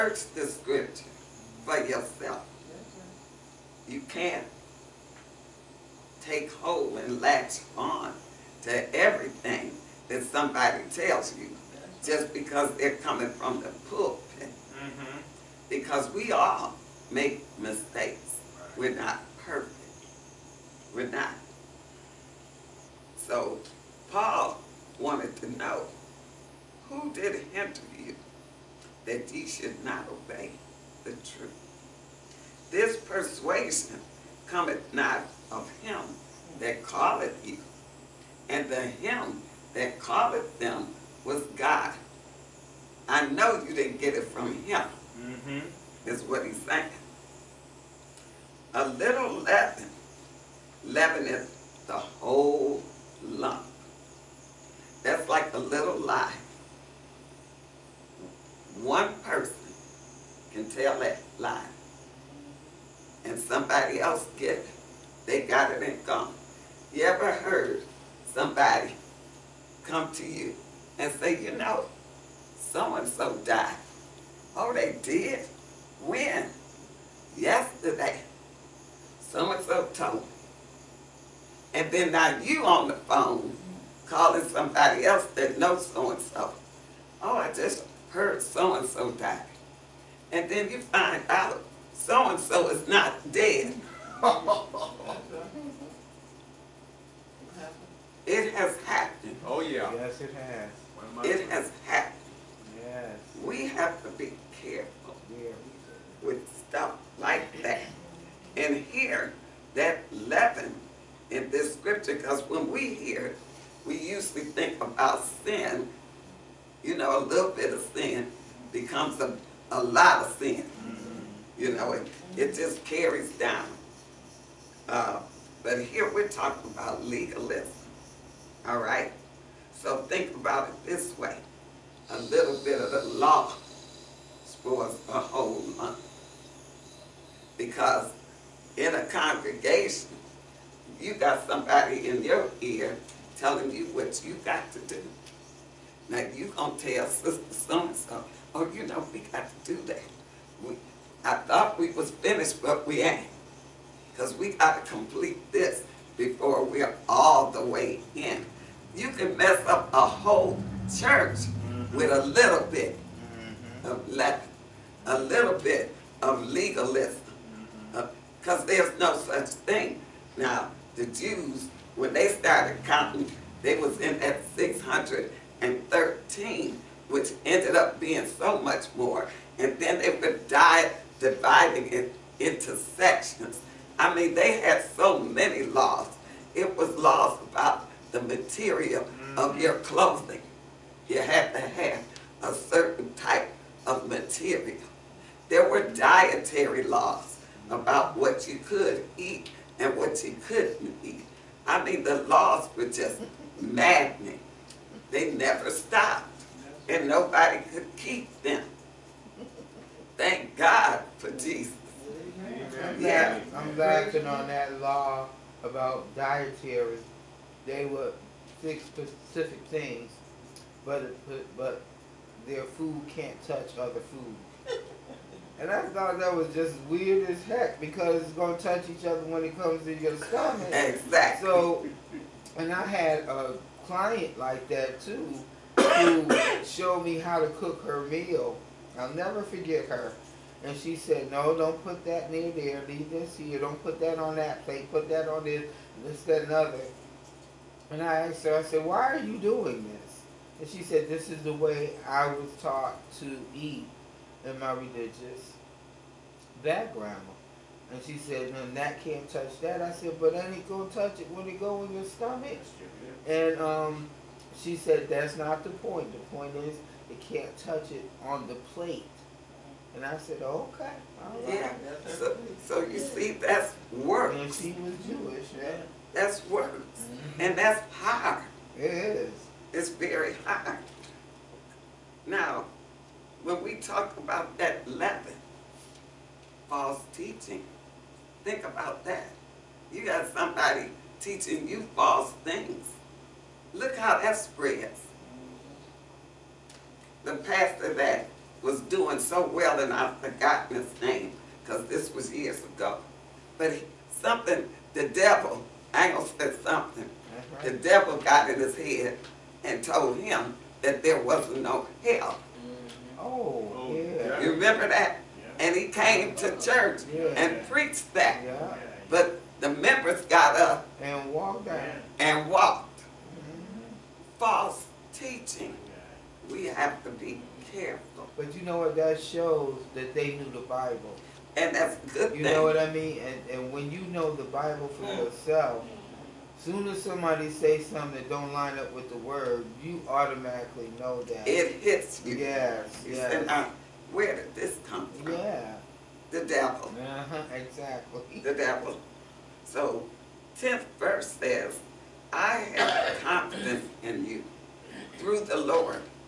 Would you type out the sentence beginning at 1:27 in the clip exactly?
Oh, I just heard so-and-so died.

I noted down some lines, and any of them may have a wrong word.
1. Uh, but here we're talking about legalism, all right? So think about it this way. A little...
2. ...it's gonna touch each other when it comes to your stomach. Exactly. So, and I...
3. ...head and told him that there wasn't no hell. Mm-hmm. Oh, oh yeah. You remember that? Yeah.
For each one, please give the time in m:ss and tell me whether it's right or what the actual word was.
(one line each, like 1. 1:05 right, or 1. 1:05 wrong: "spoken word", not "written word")
1. 2:04 right
2. 3:48 right
3. 5:08 right.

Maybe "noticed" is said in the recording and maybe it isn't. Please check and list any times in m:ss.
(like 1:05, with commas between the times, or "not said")
not said.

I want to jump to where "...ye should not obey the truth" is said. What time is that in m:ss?
0:29.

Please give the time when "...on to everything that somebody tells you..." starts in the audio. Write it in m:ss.
0:07.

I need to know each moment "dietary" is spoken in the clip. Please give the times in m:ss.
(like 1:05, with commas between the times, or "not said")
3:15, 3:36.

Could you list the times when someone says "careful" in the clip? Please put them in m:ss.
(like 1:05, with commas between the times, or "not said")
1:44, 5:27.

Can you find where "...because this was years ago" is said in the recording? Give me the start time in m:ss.
5:01.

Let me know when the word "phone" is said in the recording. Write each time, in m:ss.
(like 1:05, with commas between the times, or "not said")
1:22.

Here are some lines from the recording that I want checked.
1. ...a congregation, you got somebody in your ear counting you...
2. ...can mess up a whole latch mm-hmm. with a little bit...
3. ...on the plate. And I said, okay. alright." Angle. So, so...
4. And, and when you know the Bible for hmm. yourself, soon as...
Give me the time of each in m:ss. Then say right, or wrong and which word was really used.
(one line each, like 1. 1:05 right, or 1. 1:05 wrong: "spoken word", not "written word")
1. 2:18 wrong: "telling", not "counting"
2. 2:39 wrong: "church", not "latch"
3. 4:28 wrong: "Yeah", not "Angle"
4. 5:33 right.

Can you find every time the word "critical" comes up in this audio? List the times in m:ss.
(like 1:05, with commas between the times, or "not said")
not said.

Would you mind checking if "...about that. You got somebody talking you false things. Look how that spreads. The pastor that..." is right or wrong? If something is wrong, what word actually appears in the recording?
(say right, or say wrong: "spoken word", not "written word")
wrong: "teaching", not "talking".